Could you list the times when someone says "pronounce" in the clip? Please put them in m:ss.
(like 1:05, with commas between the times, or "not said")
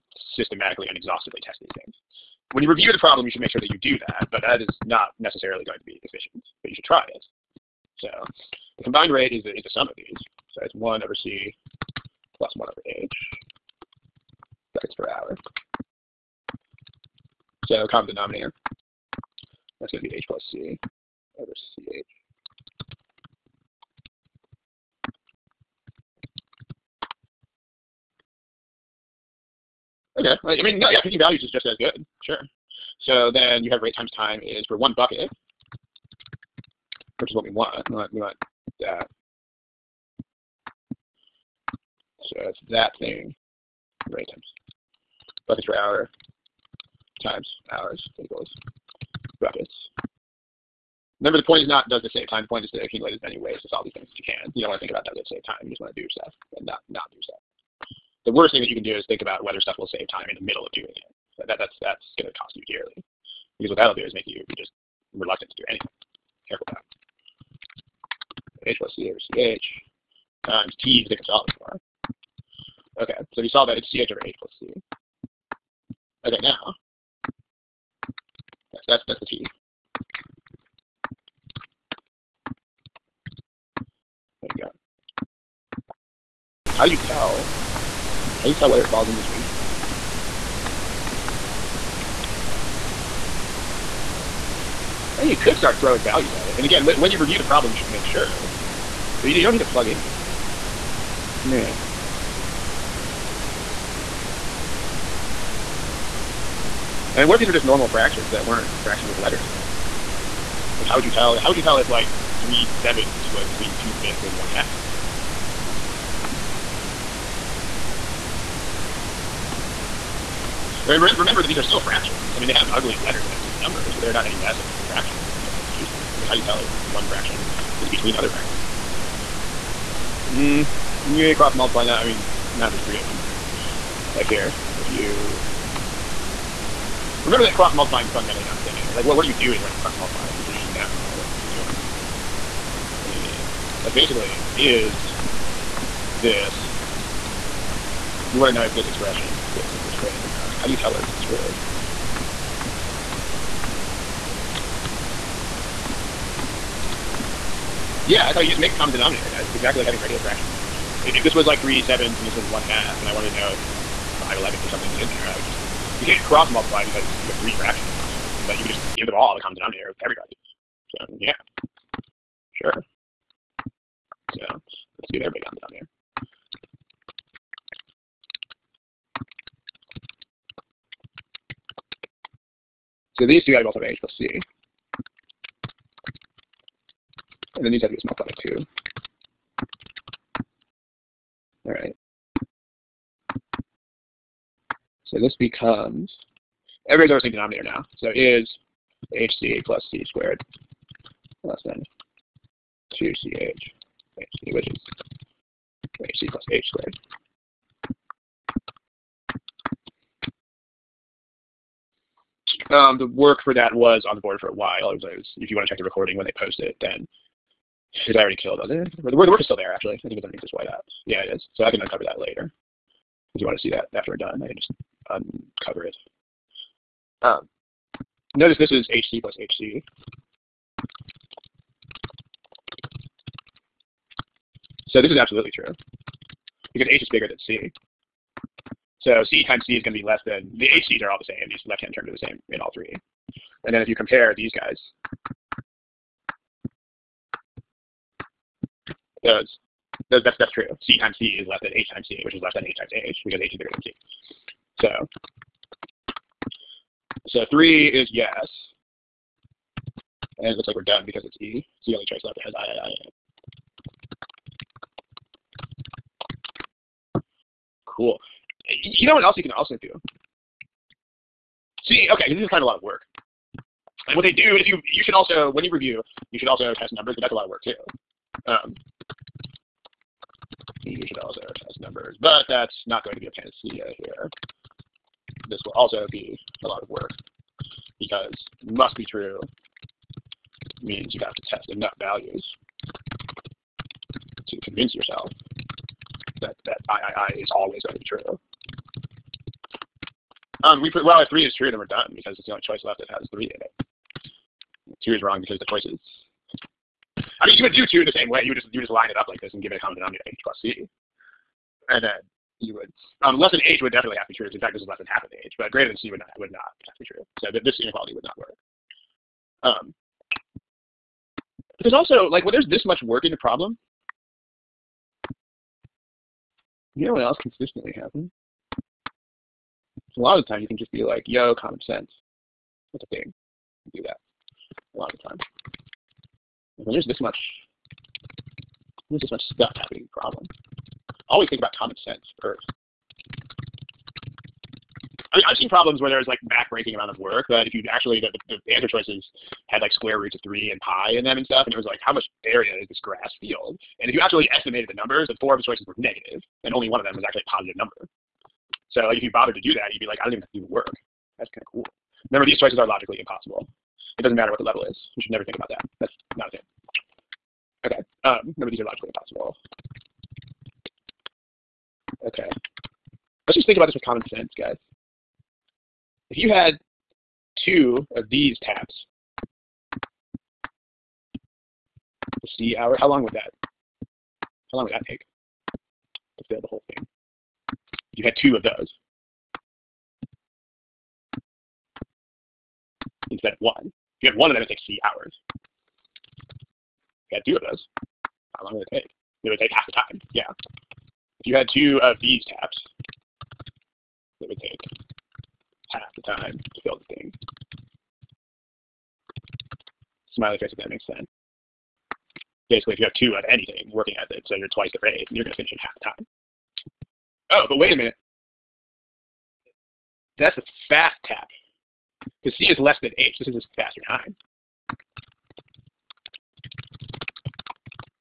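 not said.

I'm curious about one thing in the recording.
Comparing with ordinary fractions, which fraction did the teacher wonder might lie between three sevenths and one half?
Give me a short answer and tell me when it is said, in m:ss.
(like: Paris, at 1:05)
5/11, at 2:44.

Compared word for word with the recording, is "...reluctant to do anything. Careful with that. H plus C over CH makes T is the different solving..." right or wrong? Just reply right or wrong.
wrong.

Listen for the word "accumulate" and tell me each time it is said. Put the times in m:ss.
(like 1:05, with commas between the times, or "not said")
0:52.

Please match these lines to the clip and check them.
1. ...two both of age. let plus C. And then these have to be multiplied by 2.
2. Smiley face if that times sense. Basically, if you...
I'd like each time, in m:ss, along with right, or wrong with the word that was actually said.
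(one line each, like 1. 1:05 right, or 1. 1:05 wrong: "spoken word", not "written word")
1. 3:03 right
2. 6:50 wrong: "makes", not "times".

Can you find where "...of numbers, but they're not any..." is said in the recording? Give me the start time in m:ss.
2:03.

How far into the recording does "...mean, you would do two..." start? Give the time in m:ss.
5:07.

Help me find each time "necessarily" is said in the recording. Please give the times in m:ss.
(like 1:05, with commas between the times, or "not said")
0:05.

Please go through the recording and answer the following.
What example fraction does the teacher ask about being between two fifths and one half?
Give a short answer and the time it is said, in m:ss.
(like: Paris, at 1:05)
3/7, at 1:52.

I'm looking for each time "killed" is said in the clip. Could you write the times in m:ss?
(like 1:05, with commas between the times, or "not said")
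3:38.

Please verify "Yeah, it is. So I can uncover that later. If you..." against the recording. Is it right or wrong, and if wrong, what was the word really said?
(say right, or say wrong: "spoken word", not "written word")
right.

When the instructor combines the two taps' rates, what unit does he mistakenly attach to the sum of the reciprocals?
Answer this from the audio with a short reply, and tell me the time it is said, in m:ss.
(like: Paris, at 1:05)
seconds per hour, at 0:14.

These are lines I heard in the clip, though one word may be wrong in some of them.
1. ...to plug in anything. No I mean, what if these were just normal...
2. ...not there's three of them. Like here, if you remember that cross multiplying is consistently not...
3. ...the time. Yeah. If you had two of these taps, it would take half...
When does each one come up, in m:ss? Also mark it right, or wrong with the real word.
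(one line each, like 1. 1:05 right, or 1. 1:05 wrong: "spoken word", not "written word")
1. 1:39 right
2. 2:12 wrong: "fundamentally", not "consistently"
3. 6:39 right.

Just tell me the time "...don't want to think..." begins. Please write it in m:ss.
0:54.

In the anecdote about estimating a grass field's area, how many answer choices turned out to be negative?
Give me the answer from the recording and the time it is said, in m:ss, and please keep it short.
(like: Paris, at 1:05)
4, at 5:55.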